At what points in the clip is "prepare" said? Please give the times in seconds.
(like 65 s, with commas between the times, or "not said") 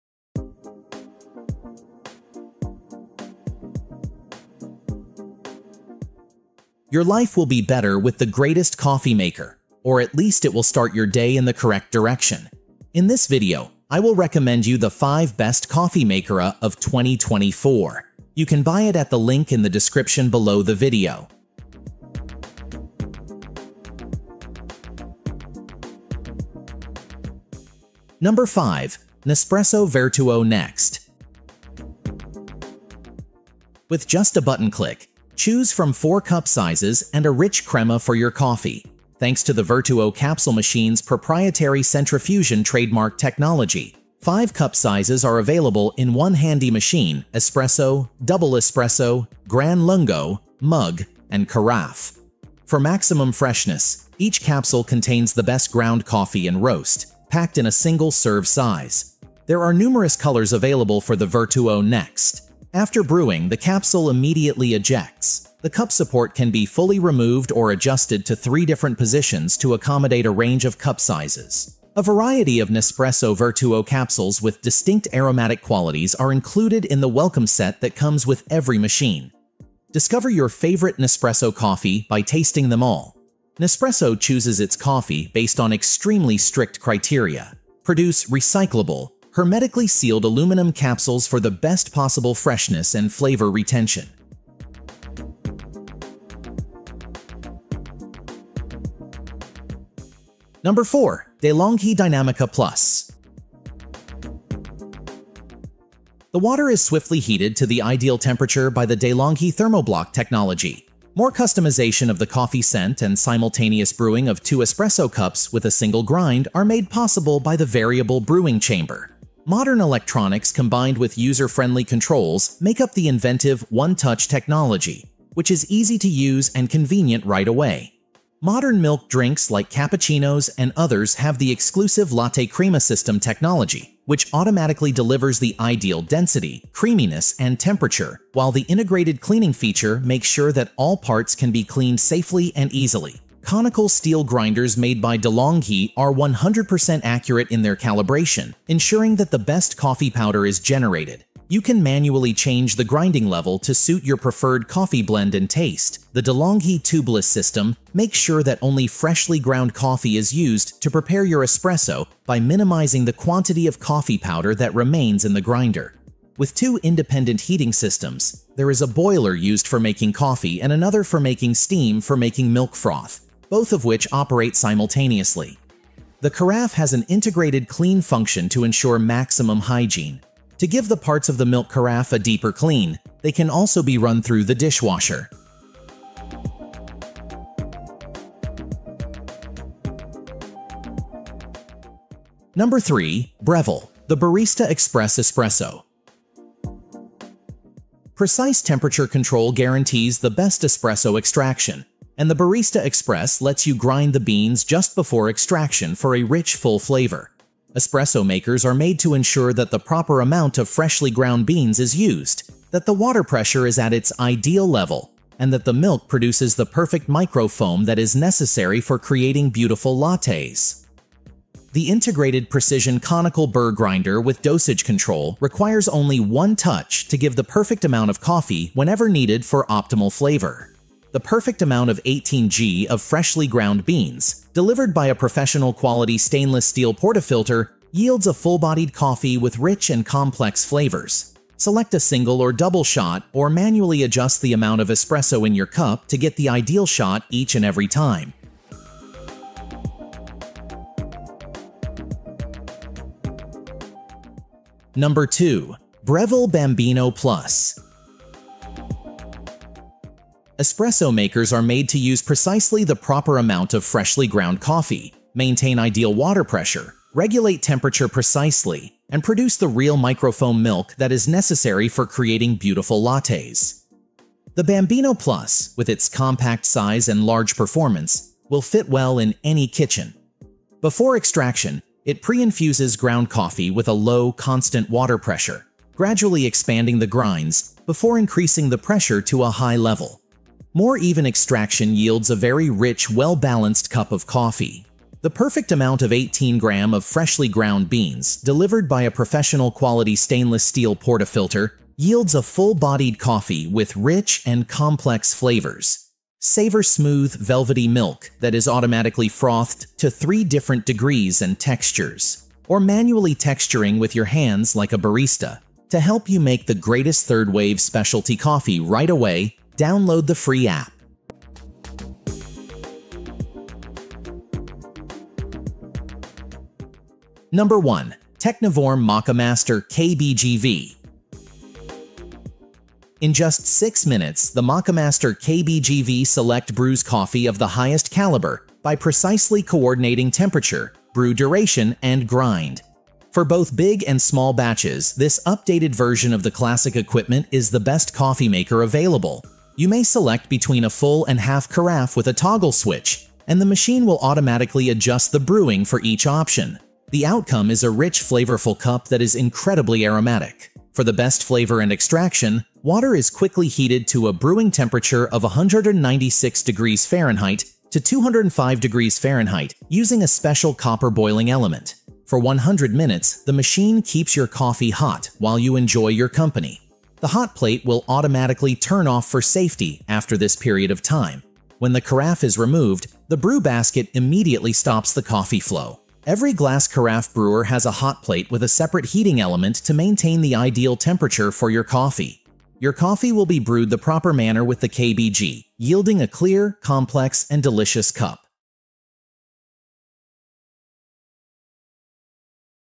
160 s.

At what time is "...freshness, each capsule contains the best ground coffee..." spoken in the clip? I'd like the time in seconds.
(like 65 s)
53 s.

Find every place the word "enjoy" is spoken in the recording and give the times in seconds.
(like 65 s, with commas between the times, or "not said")
375 s.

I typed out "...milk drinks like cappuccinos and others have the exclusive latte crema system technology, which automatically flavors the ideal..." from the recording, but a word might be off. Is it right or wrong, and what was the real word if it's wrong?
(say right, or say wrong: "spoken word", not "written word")
wrong: "delivers", not "flavors".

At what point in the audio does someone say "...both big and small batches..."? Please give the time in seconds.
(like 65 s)
343 s.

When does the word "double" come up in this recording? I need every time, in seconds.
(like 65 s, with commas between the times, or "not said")
48 s, 242 s.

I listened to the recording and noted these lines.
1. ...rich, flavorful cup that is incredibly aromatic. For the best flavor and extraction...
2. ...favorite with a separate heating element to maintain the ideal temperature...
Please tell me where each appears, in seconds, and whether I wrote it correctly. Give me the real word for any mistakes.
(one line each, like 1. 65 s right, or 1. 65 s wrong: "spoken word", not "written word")
1. 357 s right
2. 388 s wrong: "plate", not "favorite".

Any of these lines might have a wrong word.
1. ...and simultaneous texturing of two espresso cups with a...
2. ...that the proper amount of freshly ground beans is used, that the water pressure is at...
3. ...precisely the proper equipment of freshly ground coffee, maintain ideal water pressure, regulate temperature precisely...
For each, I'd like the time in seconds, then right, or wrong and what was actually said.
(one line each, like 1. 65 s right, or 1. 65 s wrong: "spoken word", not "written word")
1. 113 s wrong: "brewing", not "texturing"
2. 209 s right
3. 262 s wrong: "amount", not "equipment".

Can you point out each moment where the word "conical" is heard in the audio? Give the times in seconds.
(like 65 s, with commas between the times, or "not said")
143 s, 222 s.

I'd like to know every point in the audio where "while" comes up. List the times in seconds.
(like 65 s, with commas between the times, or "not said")
138 s, 375 s.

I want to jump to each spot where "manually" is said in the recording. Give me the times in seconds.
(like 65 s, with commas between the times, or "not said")
151 s, 243 s, 312 s.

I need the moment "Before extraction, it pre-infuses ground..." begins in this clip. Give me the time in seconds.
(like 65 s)
280 s.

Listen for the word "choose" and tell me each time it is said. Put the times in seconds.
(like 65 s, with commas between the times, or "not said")
35 s, 84 s.